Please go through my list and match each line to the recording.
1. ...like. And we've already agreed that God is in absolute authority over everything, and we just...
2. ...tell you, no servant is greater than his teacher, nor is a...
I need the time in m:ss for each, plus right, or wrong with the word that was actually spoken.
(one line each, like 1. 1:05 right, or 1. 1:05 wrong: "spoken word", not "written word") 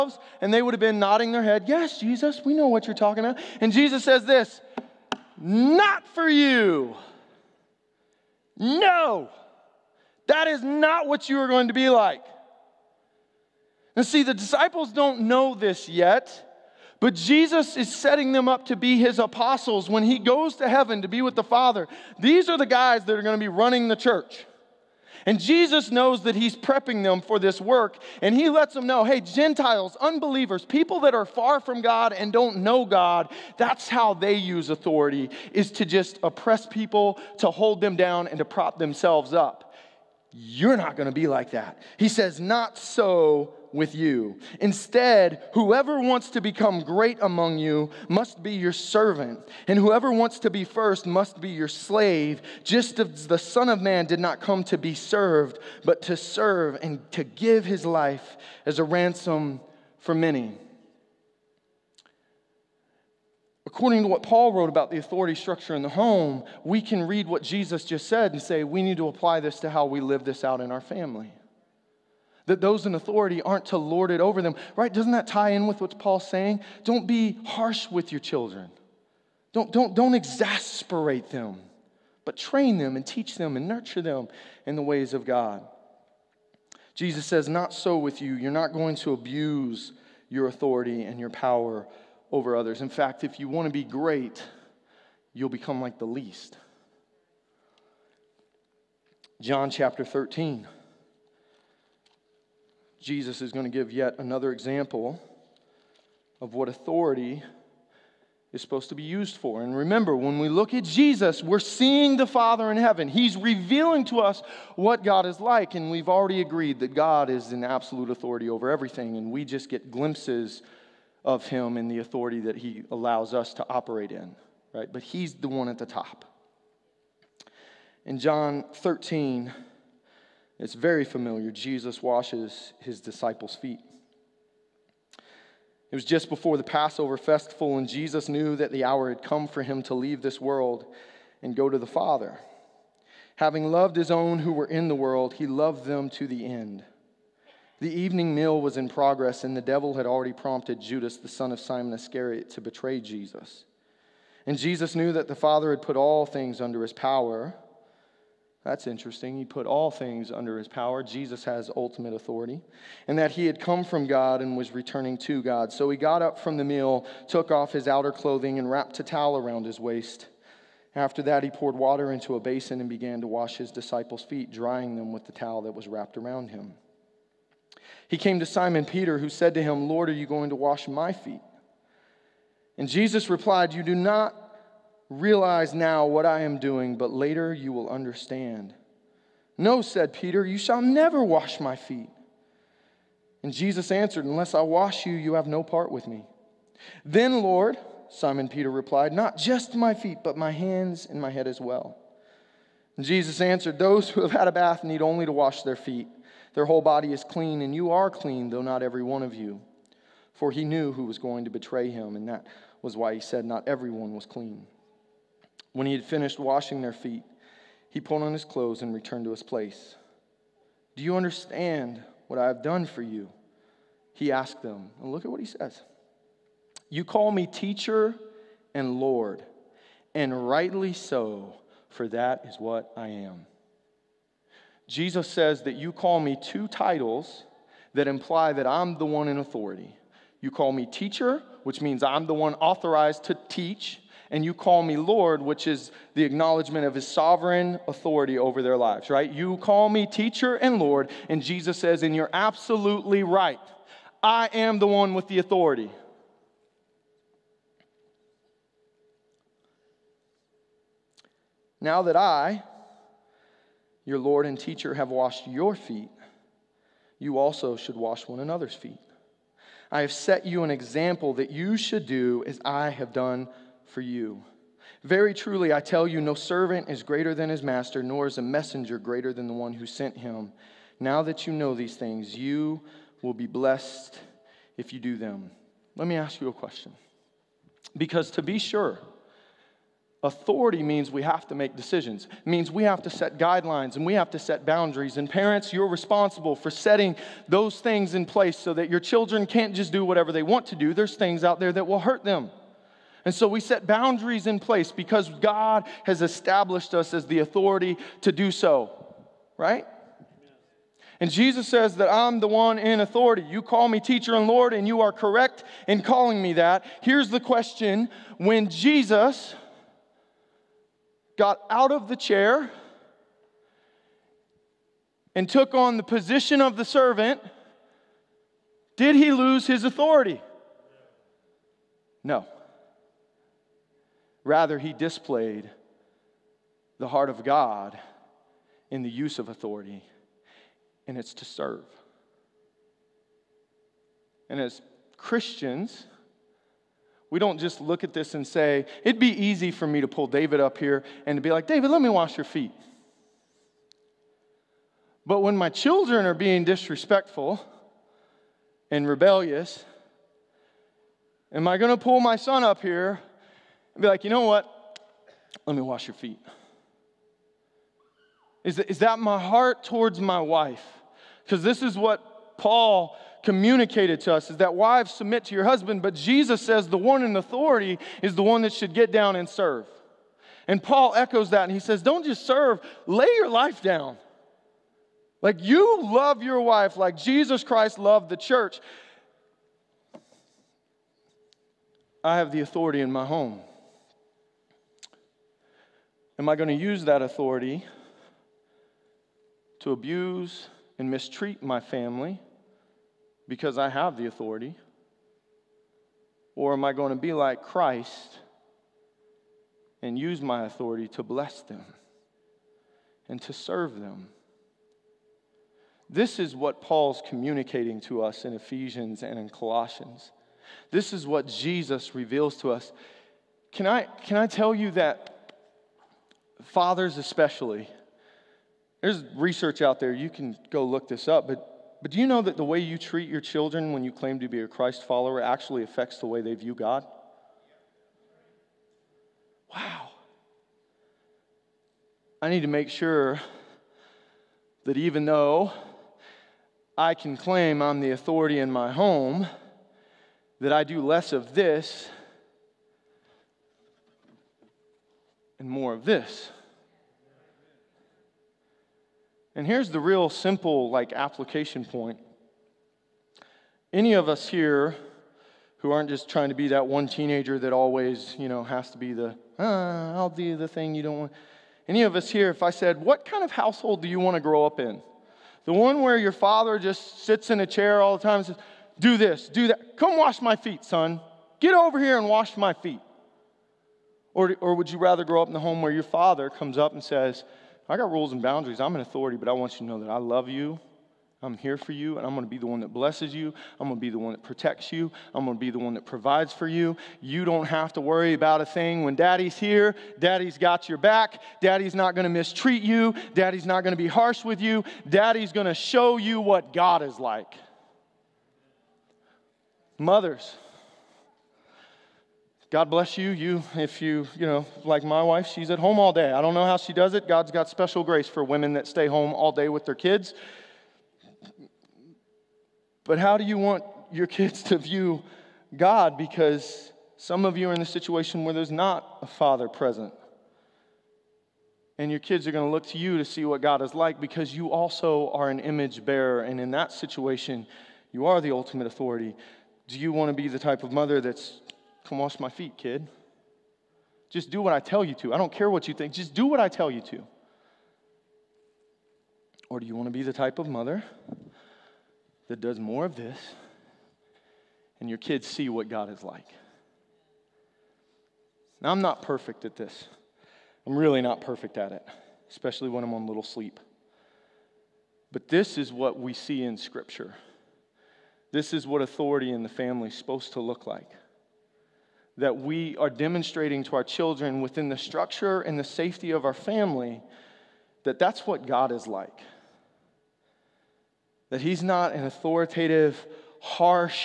1. 1:55 right
2. 4:35 wrong: "master", not "teacher".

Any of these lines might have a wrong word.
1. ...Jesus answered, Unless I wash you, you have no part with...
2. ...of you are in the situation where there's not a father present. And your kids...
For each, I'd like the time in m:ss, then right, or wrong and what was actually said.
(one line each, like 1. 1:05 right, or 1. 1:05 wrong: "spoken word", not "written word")
1. 3:13 right
2. 8:47 right.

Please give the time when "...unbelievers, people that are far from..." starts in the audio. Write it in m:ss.
0:29.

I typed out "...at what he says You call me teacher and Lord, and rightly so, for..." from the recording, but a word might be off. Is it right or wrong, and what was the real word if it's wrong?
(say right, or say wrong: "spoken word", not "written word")
right.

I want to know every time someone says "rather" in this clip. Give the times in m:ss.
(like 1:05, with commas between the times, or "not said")
5:34, 8:04.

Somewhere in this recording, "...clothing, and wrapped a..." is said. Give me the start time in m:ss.
2:48.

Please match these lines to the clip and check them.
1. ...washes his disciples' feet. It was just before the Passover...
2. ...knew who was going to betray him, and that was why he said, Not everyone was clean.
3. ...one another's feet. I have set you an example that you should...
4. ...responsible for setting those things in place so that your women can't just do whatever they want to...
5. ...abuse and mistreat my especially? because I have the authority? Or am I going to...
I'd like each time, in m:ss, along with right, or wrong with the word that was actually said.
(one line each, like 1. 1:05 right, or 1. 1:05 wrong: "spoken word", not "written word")
1. 2:12 right
2. 3:30 right
3. 4:28 right
4. 4:55 wrong: "children", not "women"
5. 6:39 wrong: "family", not "especially".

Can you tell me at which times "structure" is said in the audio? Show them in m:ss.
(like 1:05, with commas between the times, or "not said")
1:05, 9:34.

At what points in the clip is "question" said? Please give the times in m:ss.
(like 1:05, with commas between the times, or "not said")
4:46, 5:17.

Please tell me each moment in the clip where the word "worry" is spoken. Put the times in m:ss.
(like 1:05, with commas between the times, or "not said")
8:18.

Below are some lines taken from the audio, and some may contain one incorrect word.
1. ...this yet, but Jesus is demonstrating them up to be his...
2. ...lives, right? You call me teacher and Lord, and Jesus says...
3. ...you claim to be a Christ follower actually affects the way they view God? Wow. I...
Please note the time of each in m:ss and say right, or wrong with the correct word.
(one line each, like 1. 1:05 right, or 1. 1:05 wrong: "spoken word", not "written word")
1. 0:15 wrong: "setting", not "demonstrating"
2. 4:08 right
3. 7:14 right.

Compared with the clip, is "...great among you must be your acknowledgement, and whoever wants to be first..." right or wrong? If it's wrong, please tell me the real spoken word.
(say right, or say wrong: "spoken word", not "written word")
wrong: "servant", not "acknowledgement".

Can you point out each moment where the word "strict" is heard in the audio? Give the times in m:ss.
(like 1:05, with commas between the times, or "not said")
not said.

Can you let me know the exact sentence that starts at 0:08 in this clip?
No, that is not what you are going to be like.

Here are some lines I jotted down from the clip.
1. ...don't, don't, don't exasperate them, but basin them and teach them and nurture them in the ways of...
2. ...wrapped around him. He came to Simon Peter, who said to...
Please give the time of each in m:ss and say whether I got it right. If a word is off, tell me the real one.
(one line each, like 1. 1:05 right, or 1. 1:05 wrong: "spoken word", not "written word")
1. 1:19 wrong: "train", not "basin"
2. 2:55 right.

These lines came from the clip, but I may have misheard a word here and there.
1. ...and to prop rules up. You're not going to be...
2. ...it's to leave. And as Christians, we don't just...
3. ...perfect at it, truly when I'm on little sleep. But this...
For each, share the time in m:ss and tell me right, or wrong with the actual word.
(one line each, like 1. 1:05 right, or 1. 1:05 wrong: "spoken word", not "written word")
1. 0:38 wrong: "themselves", not "rules"
2. 5:41 wrong: "serve", not "leave"
3. 9:21 wrong: "especially", not "truly".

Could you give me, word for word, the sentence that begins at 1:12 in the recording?
That those in authority aren't to lord it over them, right?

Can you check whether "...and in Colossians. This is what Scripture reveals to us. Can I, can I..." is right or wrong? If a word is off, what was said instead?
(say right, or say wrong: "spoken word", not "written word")
wrong: "Jesus", not "Scripture".